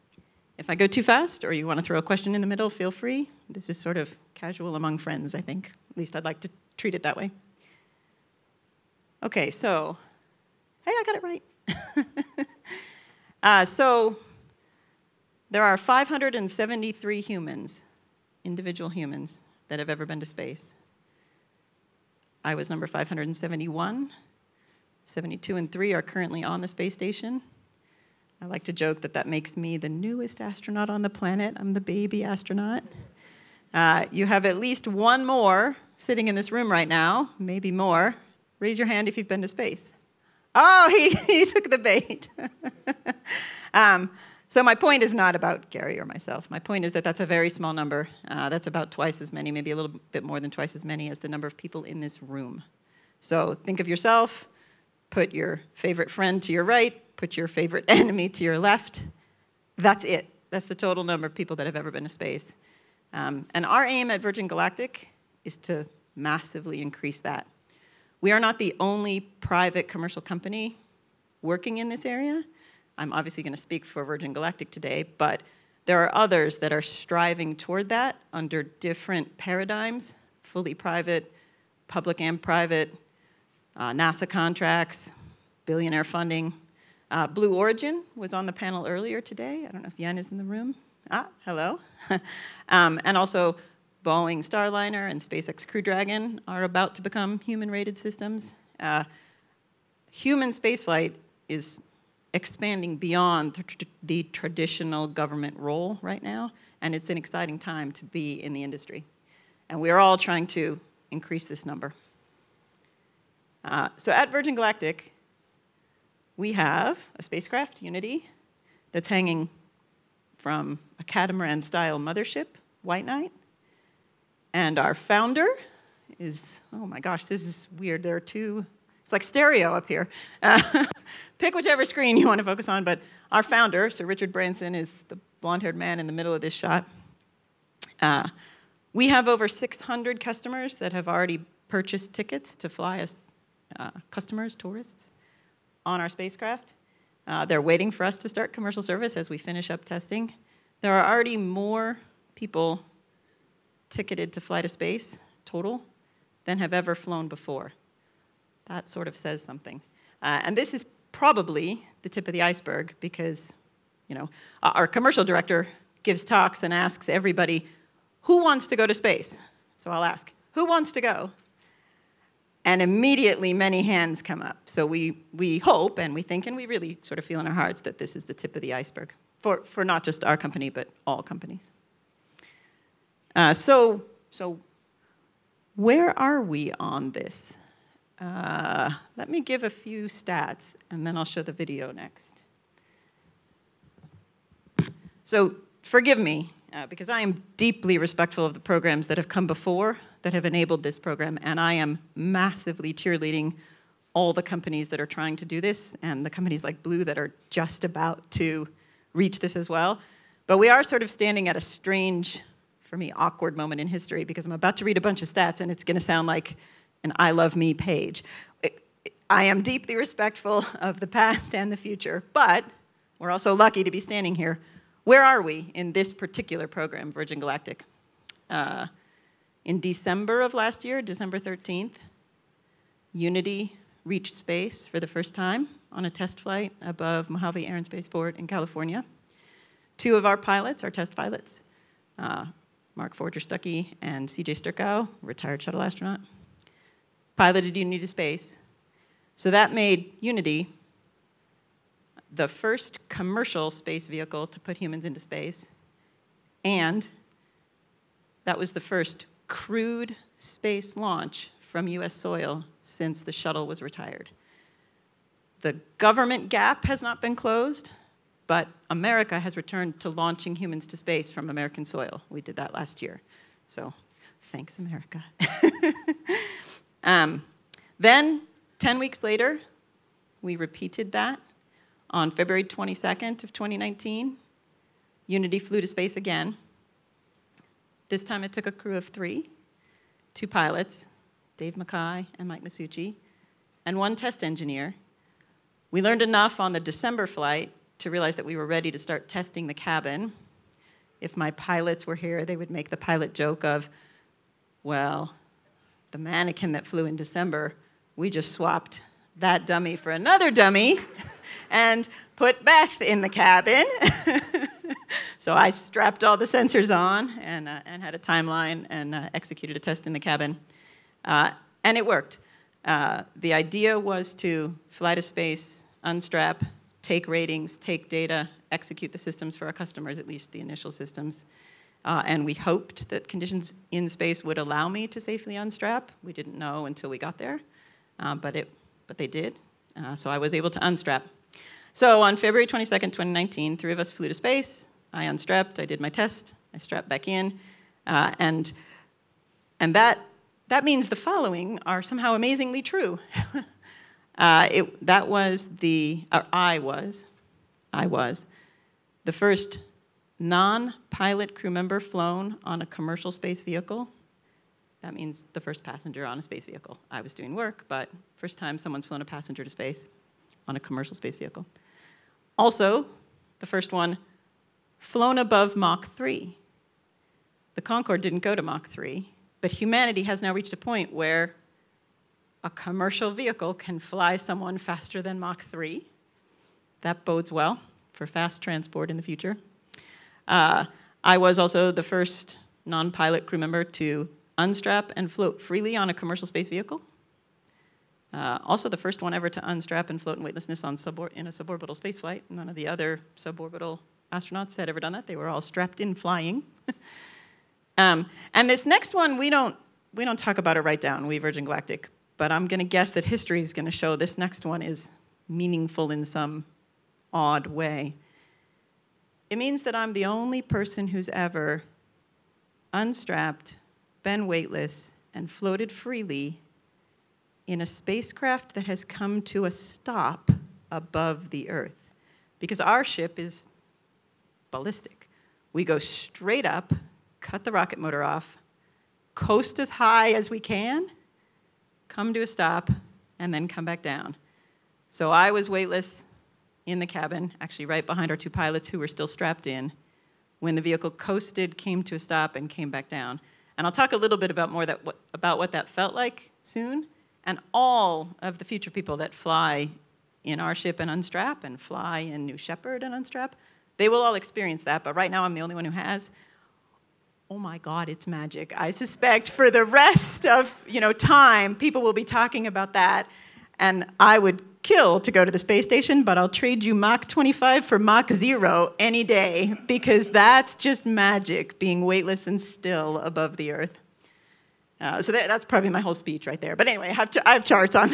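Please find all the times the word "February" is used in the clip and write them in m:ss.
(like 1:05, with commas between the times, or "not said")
4:42, 5:42.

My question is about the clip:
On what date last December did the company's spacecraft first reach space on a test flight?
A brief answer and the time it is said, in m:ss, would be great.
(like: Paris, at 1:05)
December 13th, at 3:51.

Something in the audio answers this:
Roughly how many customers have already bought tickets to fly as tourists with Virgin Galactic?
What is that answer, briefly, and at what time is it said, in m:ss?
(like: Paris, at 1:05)
over 600, at 2:19.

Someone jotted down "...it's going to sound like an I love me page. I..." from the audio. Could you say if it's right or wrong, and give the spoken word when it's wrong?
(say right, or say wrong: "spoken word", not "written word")
right.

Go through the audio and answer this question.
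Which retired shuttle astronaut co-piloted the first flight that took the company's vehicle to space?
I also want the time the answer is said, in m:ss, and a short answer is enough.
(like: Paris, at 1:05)
CJ Sturckow, at 4:04.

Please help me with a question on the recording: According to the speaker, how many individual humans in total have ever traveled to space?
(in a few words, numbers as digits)
573.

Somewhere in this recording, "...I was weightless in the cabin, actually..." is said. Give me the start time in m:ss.
7:25.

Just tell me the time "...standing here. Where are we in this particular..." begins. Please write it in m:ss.
3:44.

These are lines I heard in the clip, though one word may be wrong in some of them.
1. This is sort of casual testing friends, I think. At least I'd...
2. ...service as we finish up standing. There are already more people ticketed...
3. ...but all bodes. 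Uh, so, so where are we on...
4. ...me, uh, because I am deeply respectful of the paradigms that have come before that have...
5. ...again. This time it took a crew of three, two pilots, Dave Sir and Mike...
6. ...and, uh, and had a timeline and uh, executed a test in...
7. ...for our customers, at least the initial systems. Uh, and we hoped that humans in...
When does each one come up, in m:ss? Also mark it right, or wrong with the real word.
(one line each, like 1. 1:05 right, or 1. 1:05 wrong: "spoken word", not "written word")
1. 0:03 wrong: "among", not "testing"
2. 2:28 wrong: "testing", not "standing"
3. 3:00 wrong: "companies", not "bodes"
4. 3:16 wrong: "programs", not "paradigms"
5. 4:46 wrong: "Mackay", not "Sir"
6. 5:17 right
7. 5:29 wrong: "conditions", not "humans".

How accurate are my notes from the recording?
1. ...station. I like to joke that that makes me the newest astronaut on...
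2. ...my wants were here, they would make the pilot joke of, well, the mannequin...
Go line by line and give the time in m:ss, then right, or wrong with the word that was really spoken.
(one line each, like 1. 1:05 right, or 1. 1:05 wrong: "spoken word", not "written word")
1. 0:26 right
2. 5:01 wrong: "pilots", not "wants".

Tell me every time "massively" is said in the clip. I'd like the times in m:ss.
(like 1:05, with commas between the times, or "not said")
1:06, 3:22.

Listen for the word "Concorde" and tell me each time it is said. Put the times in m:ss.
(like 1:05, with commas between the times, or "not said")
6:17.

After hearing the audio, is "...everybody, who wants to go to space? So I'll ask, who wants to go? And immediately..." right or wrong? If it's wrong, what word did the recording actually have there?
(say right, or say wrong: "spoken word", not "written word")
right.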